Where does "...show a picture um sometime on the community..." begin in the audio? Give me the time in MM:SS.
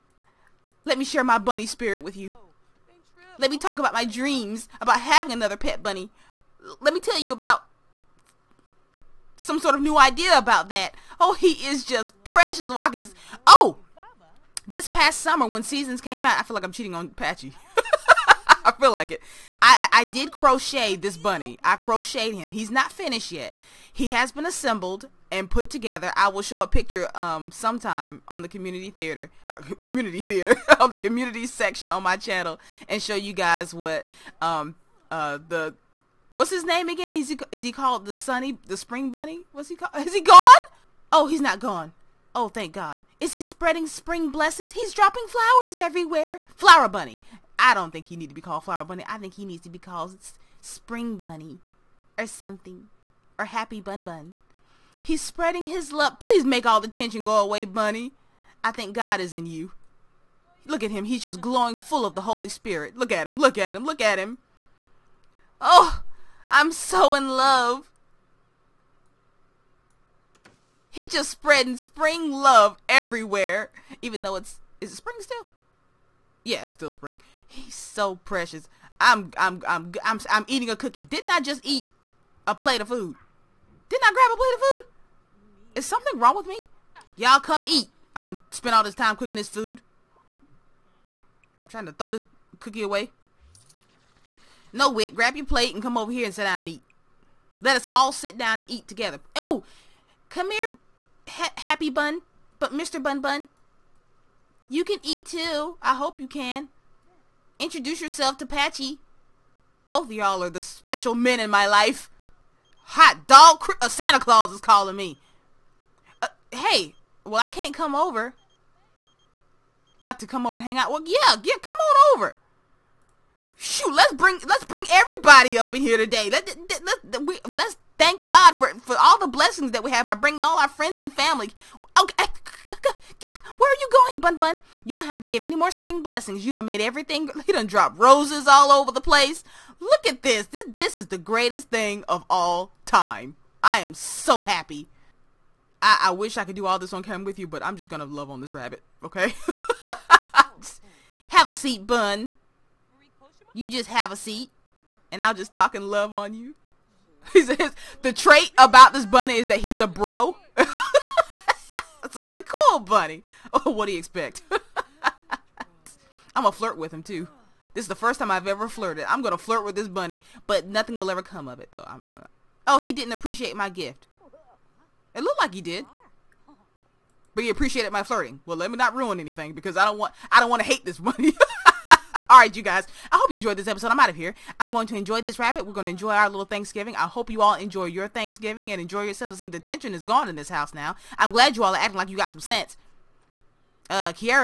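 00:26.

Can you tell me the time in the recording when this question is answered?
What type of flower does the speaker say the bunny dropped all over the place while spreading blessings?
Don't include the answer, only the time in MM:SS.
02:17.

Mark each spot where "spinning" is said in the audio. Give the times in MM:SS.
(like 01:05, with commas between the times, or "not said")
not said.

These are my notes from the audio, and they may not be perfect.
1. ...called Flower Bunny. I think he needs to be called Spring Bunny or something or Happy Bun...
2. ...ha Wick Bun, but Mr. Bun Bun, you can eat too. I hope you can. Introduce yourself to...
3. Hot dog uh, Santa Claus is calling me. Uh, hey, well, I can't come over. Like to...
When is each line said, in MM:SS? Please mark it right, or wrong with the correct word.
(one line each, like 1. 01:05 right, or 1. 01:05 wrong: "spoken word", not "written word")
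1. 00:48 right
2. 01:41 wrong: "Happy", not "Wick"
3. 01:52 right.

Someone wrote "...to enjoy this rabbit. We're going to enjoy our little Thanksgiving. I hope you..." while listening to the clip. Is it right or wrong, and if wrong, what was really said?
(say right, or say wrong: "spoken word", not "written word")
right.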